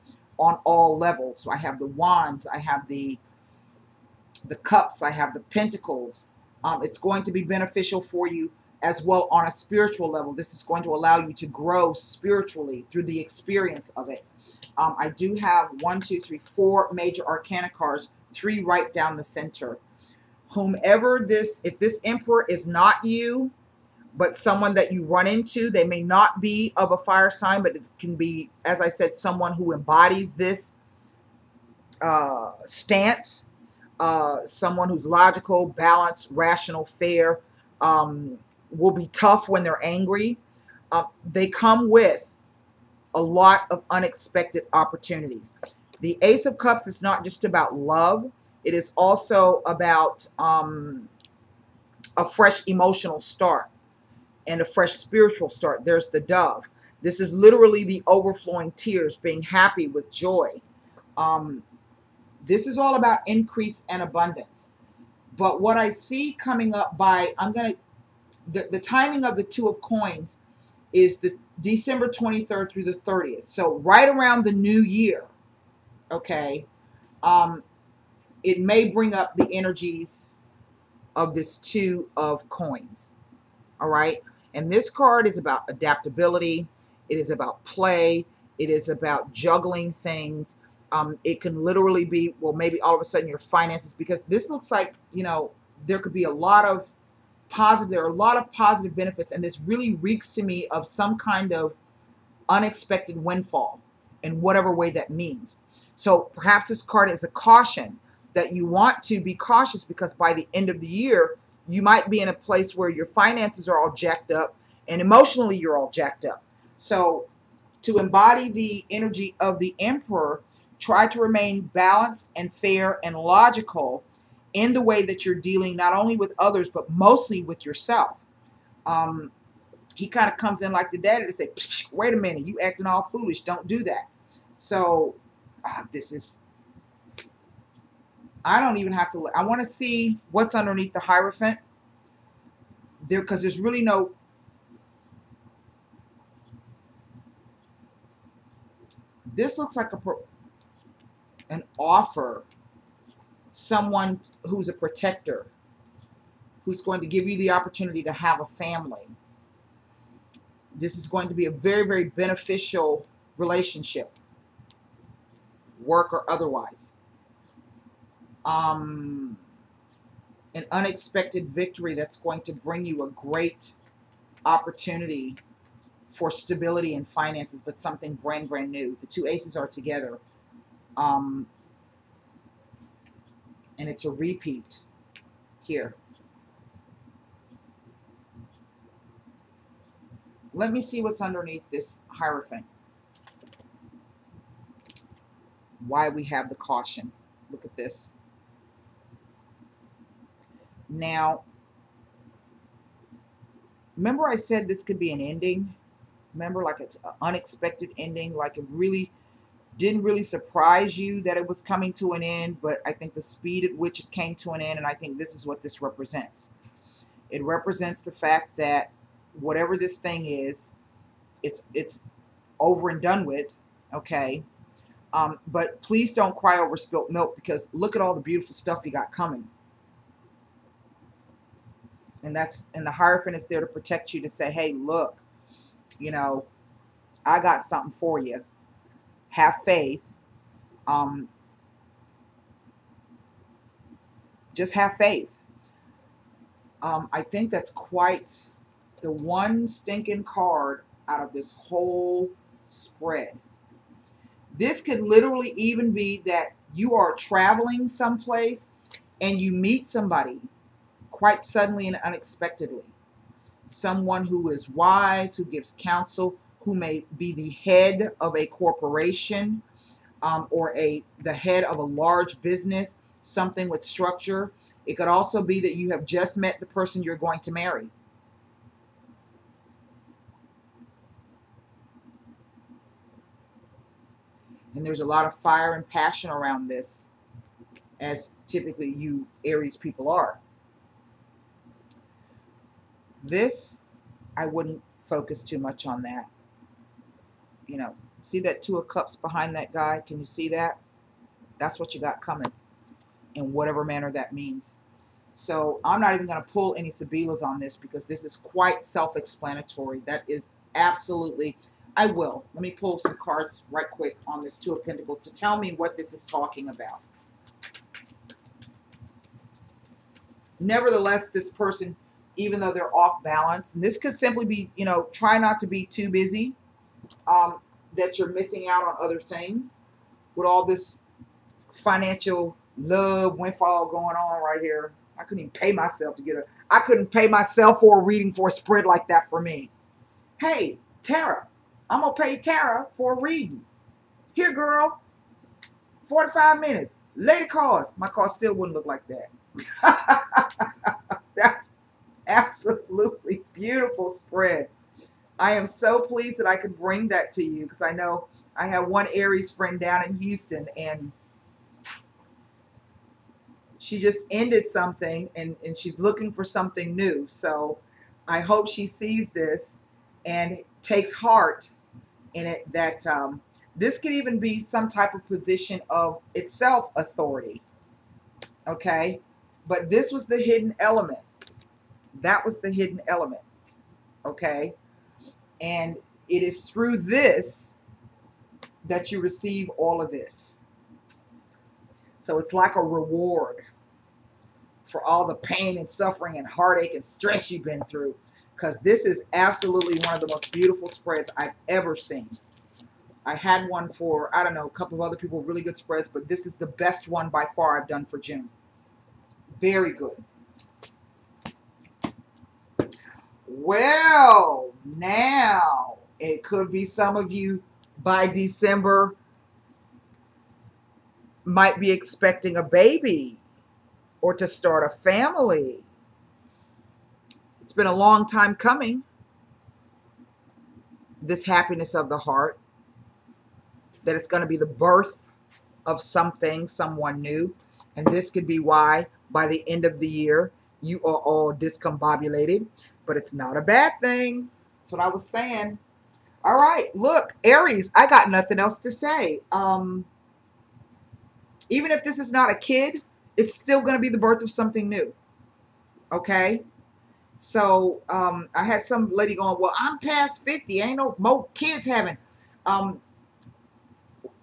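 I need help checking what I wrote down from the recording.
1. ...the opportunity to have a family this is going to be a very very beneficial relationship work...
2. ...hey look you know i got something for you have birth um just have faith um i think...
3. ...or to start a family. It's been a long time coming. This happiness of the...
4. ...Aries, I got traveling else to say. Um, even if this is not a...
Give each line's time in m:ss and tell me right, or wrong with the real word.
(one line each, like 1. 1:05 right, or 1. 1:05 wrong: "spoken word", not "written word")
1. 2:37 right
2. 3:54 wrong: "faith", not "birth"
3. 7:04 right
4. 7:27 wrong: "nothing", not "traveling".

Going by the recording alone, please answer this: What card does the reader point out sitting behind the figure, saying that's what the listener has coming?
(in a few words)
Two of Cups.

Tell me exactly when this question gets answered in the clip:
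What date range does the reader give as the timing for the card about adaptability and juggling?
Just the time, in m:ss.
1:11.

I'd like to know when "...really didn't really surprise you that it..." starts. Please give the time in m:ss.
3:28.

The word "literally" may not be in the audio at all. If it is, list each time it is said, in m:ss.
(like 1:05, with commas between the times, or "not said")
0:57, 1:31, 4:14.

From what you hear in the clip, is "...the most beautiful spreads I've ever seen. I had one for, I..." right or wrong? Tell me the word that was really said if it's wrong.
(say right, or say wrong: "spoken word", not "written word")
right.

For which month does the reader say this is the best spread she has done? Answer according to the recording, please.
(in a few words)
June.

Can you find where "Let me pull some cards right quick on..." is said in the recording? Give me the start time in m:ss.
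5:12.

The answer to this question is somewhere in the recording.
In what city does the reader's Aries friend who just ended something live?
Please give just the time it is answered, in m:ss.
6:00.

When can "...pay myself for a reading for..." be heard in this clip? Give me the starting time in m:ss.
5:37.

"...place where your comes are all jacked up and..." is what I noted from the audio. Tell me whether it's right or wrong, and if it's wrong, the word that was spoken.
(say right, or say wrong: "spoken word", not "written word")
wrong: "finances", not "comes".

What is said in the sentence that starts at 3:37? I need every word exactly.
It represents the fact that whatever this thing is, it's it's over and done with, okay?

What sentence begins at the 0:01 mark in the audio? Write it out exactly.
So I have the wands, I have the the cups, I have the pentacles.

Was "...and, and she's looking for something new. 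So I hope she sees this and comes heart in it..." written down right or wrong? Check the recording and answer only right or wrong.
wrong.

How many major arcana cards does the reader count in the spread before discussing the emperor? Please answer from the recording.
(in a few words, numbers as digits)
4.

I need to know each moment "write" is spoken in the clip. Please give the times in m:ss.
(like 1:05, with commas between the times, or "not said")
not said.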